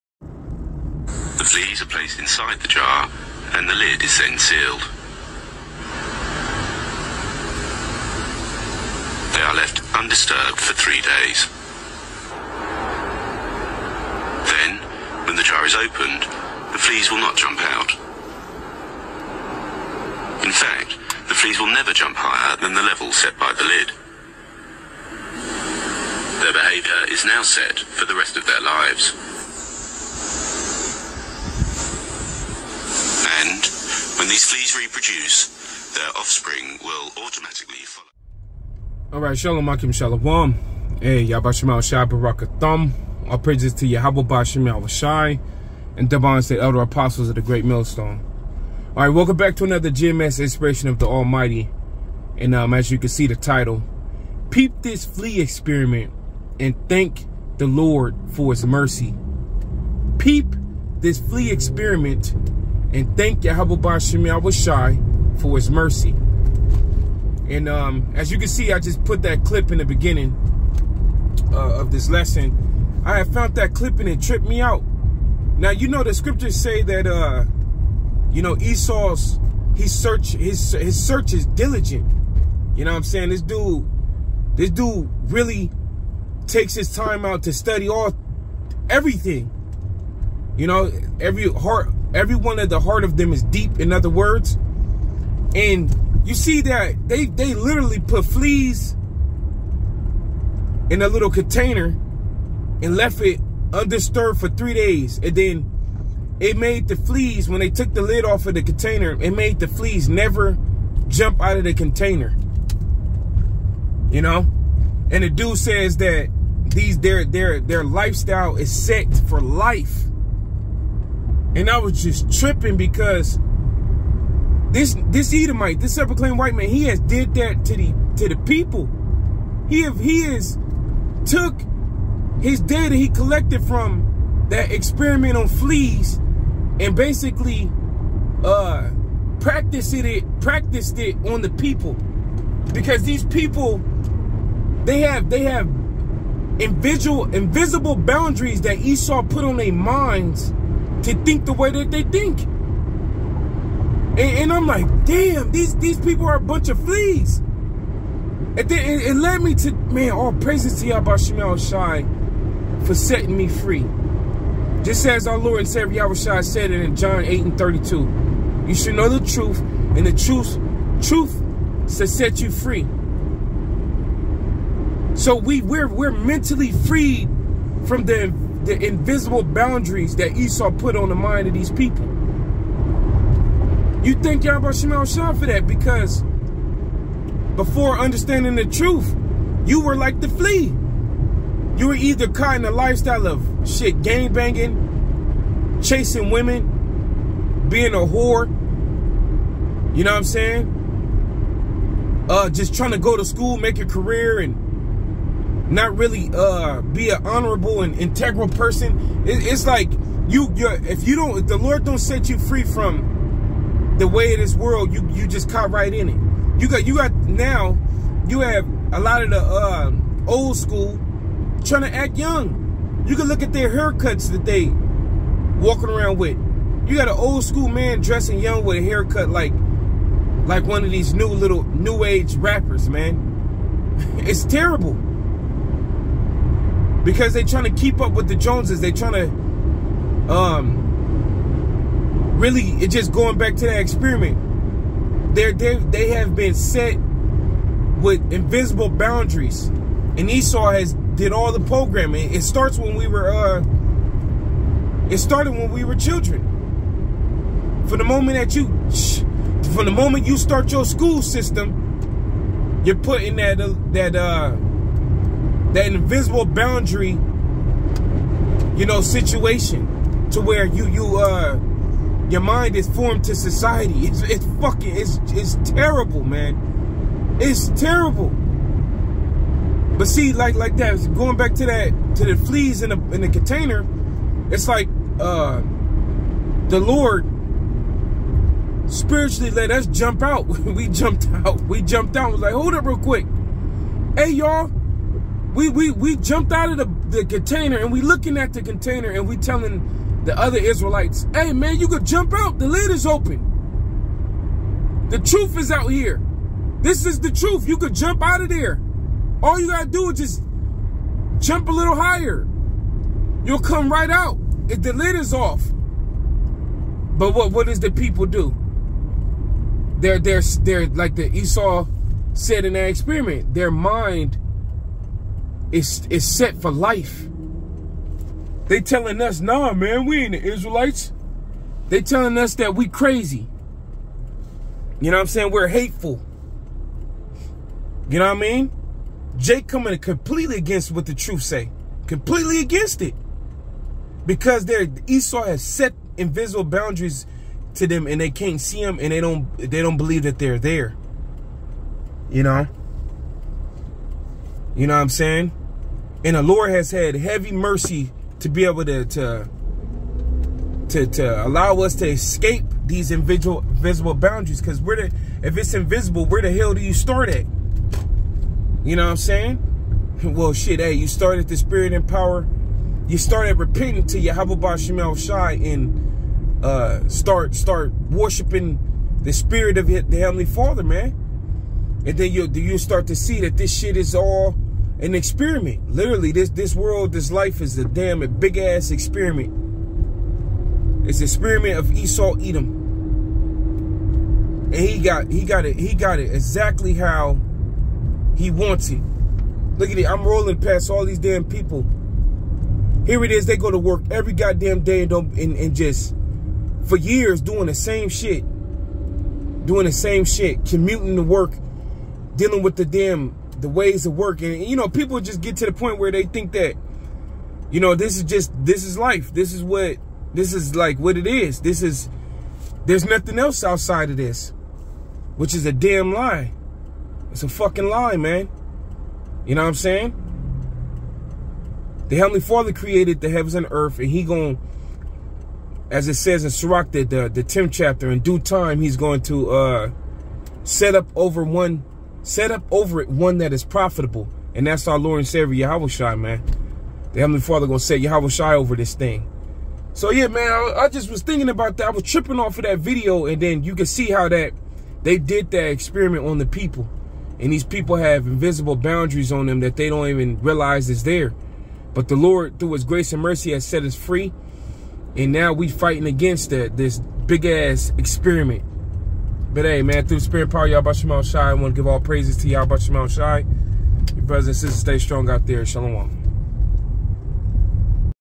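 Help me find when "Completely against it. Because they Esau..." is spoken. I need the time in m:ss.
5:42.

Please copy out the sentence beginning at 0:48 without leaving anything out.
All right, welcome back to another GMS Inspiration of the Almighty.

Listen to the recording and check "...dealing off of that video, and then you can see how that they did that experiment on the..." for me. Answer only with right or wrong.
wrong.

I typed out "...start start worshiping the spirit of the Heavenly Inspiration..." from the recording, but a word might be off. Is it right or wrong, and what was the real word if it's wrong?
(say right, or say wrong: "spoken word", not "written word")
wrong: "Father", not "Inspiration".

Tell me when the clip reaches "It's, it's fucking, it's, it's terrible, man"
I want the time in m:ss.
4:34.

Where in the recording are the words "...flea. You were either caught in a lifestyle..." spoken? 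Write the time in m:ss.
3:10.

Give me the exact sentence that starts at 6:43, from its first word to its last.
Here it is, they go to work every goddamn day and don't and, and just for years doing the same shit.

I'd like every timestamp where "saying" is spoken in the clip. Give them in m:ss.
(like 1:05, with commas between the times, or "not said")
1:23, 3:20, 5:35, 5:55, 6:09, 7:09.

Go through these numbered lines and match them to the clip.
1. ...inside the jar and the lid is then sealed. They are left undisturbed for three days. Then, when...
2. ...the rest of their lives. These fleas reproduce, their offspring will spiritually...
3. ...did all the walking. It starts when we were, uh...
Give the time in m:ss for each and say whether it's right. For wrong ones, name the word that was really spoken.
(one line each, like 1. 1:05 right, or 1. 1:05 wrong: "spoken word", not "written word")
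1. 0:02 right
2. 0:28 wrong: "automatically", not "spiritually"
3. 4:11 wrong: "programming", not "walking".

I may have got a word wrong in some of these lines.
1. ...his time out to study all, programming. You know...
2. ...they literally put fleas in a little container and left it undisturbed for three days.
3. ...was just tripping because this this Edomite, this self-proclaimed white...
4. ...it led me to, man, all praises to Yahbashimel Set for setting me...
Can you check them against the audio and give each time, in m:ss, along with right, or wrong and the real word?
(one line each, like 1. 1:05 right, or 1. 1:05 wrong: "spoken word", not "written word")
1. 1:26 wrong: "everything", not "programming"
2. 1:37 right
3. 2:01 right
4. 2:39 wrong: "Shai", not "Set".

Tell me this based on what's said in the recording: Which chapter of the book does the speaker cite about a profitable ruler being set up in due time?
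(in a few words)
10th.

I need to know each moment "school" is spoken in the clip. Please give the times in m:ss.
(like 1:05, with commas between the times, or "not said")
3:23, 3:40, 3:47, 4:20.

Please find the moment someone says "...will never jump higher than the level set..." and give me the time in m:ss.
0:21.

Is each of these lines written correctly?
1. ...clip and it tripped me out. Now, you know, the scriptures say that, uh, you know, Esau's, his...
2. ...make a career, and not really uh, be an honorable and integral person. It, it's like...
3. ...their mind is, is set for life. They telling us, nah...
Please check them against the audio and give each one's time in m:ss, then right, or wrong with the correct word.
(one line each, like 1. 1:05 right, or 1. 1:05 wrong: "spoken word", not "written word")
1. 1:13 right
2. 3:23 right
3. 5:23 right.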